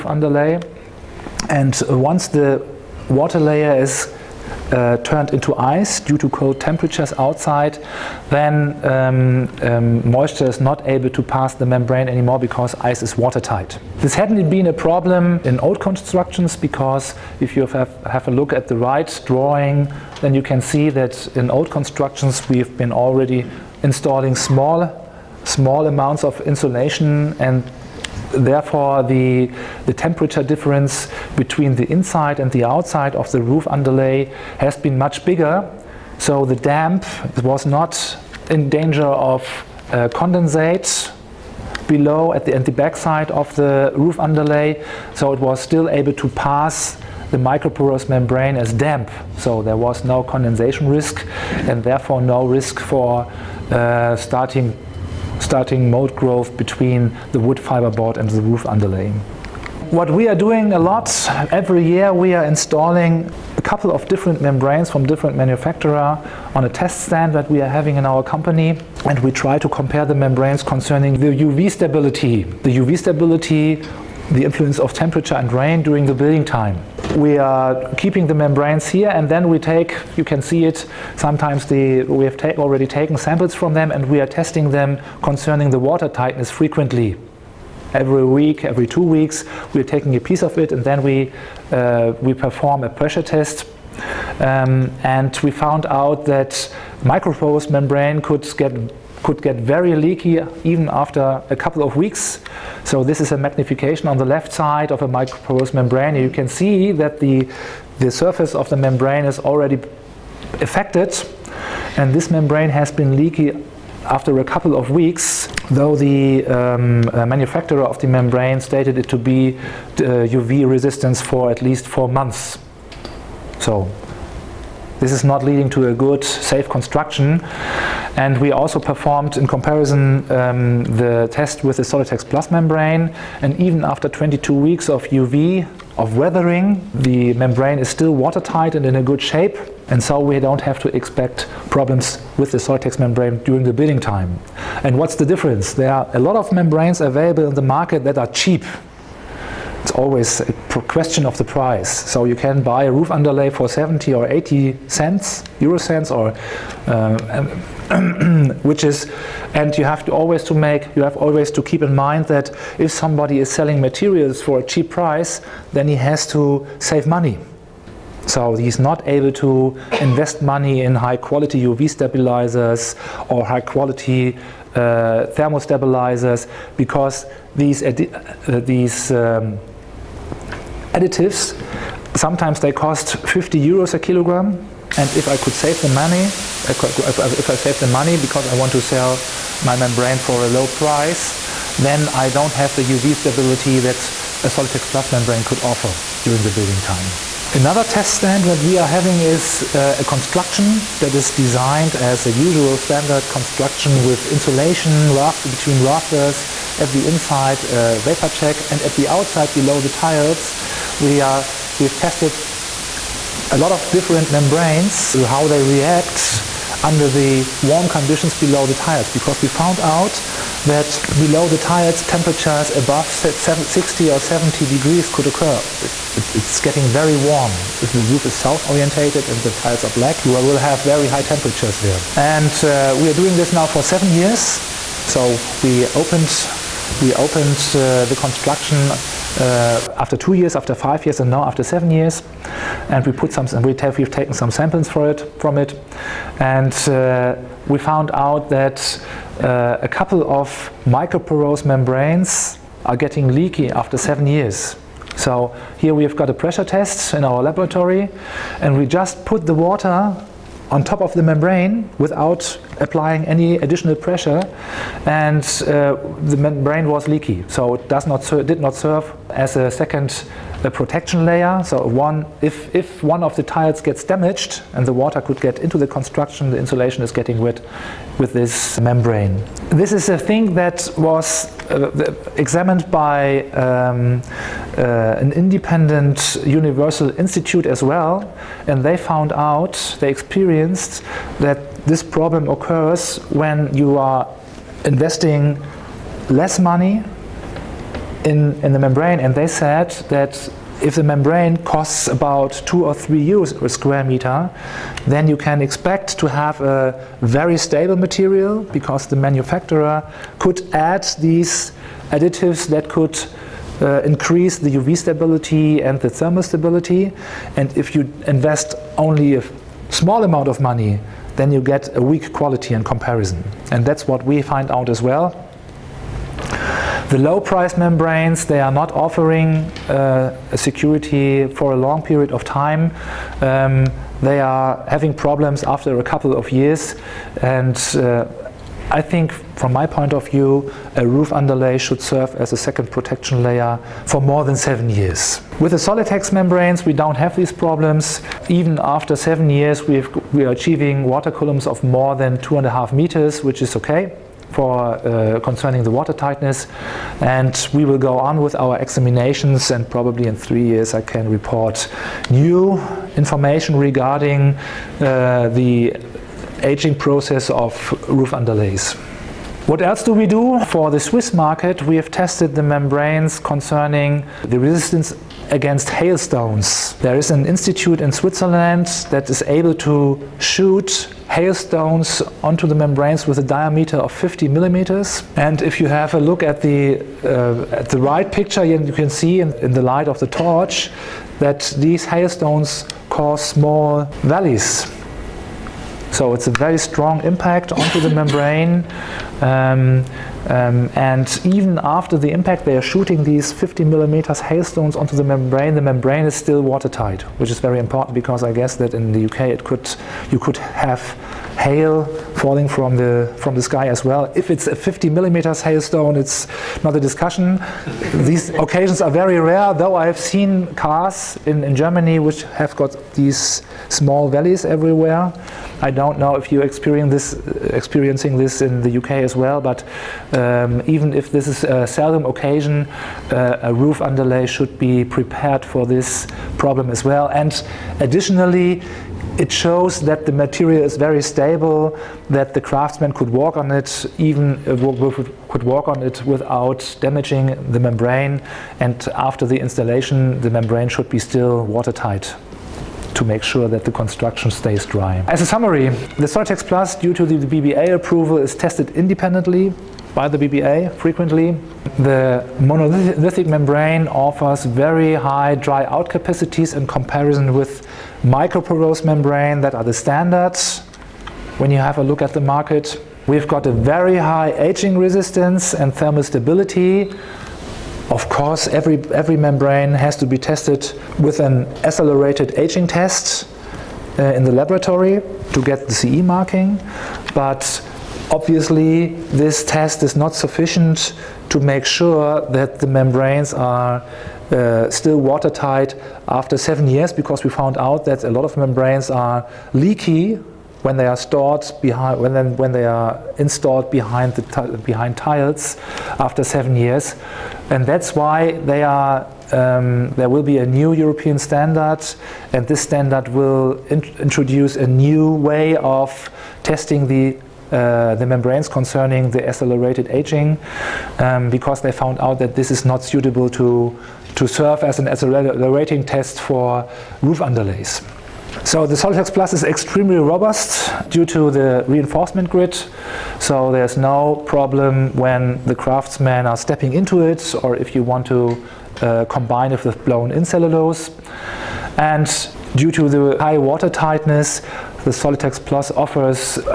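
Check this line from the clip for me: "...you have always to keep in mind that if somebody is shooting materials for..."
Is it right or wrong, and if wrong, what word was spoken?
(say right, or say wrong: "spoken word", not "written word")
wrong: "selling", not "shooting".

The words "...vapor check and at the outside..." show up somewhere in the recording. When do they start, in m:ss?
3:27.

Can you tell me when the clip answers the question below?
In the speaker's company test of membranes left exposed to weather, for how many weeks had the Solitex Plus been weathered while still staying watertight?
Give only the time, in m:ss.
2:14.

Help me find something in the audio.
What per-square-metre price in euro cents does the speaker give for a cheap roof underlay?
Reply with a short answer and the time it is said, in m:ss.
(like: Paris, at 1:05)
70 or 80 cents, at 2:33.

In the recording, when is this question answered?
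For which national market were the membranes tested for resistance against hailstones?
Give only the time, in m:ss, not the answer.
6:10.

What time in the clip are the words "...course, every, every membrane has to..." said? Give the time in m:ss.
7:58.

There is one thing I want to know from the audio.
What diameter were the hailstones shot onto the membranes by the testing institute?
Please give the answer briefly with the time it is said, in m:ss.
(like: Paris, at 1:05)
50 millimeters, at 6:23.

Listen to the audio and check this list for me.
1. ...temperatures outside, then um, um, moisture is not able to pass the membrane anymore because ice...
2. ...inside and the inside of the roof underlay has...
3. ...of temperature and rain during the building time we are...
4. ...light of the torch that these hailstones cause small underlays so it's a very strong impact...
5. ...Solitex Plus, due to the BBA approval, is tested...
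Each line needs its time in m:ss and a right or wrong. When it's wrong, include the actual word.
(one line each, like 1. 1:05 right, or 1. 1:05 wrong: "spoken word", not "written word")
1. 0:06 right
2. 0:31 wrong: "outside", not "inside"
3. 1:14 right
4. 6:29 wrong: "valleys", not "underlays"
5. 7:36 right.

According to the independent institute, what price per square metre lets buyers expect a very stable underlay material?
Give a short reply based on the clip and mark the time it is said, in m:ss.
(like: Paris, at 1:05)
2 or 3 euros, at 5:02.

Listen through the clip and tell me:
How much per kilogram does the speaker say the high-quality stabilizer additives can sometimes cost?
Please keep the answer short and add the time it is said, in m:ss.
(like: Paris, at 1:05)
50 euros, at 3:03.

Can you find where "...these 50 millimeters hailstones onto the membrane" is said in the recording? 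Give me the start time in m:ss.
6:43.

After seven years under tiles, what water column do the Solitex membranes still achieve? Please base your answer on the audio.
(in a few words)
2.5 meters.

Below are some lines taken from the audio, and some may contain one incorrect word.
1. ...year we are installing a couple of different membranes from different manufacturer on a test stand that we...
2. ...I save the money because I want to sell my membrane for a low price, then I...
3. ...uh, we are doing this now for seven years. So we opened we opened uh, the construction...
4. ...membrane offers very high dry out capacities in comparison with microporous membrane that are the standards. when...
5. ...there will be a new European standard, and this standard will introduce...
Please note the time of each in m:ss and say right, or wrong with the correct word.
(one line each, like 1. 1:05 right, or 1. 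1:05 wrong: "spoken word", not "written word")
1. 1:01 right
2. 3:07 right
3. 3:52 right
4. 7:43 right
5. 8:30 right.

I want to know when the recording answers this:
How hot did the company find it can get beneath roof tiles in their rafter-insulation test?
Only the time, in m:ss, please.
3:43.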